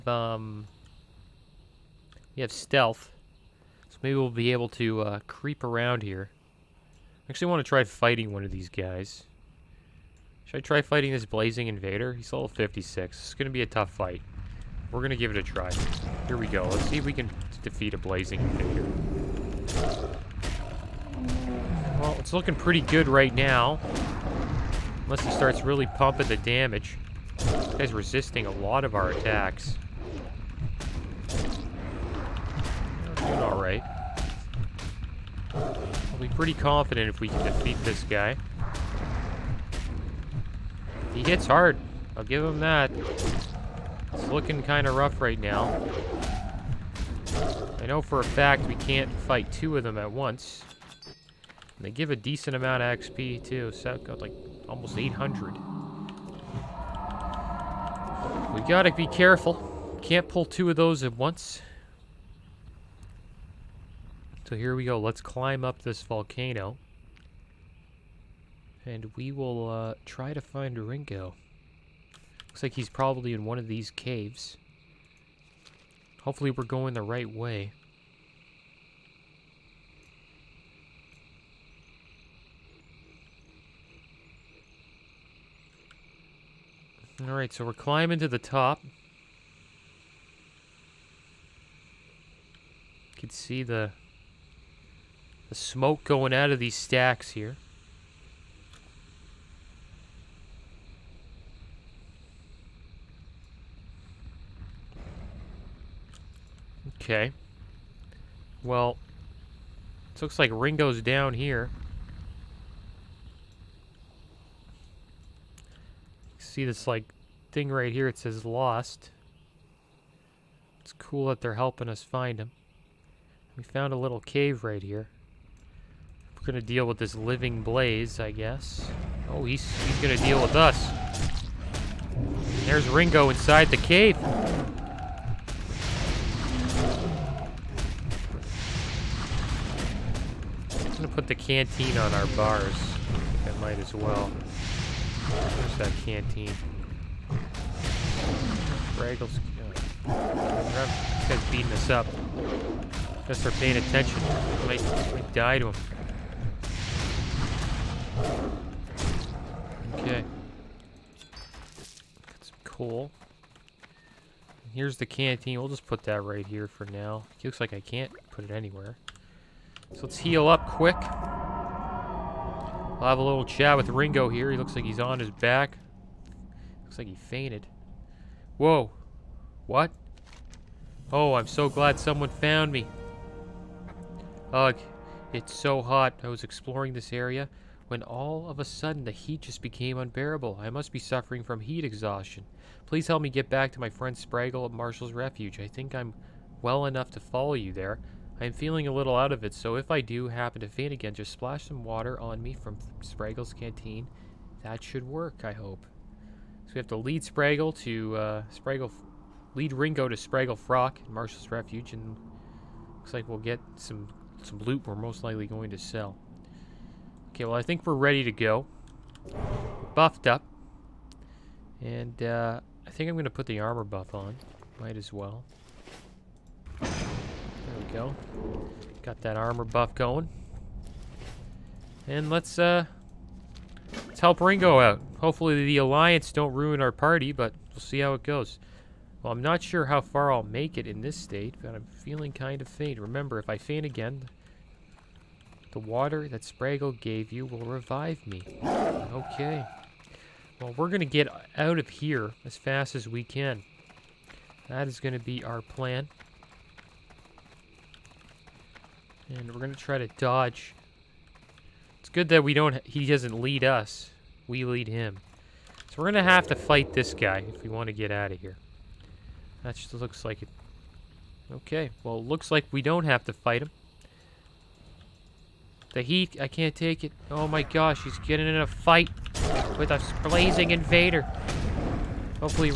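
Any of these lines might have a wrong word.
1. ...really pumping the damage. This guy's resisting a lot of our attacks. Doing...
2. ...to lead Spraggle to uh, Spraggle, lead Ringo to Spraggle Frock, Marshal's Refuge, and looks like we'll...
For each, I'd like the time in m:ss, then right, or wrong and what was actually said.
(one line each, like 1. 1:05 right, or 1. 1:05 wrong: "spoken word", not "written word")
1. 0:25 right
2. 3:26 right.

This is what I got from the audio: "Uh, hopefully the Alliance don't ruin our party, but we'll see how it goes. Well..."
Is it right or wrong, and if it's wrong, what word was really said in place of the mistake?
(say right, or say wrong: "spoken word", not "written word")
right.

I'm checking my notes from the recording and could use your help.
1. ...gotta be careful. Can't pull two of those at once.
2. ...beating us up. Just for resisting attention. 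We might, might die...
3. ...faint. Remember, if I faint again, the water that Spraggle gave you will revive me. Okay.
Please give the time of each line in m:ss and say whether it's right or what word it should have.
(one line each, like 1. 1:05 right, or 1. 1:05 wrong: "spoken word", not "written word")
1. 0:58 right
2. 2:31 wrong: "paying", not "resisting"
3. 4:02 right.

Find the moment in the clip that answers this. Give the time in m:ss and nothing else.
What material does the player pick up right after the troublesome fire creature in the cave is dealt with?
2:42.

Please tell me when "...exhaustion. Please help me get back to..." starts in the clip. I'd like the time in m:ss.
3:11.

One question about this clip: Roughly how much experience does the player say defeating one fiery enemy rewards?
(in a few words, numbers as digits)
almost 800.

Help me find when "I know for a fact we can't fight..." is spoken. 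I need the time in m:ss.
0:47.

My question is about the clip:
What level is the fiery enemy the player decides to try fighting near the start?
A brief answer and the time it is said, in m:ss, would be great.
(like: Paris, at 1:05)
56, at 0:12.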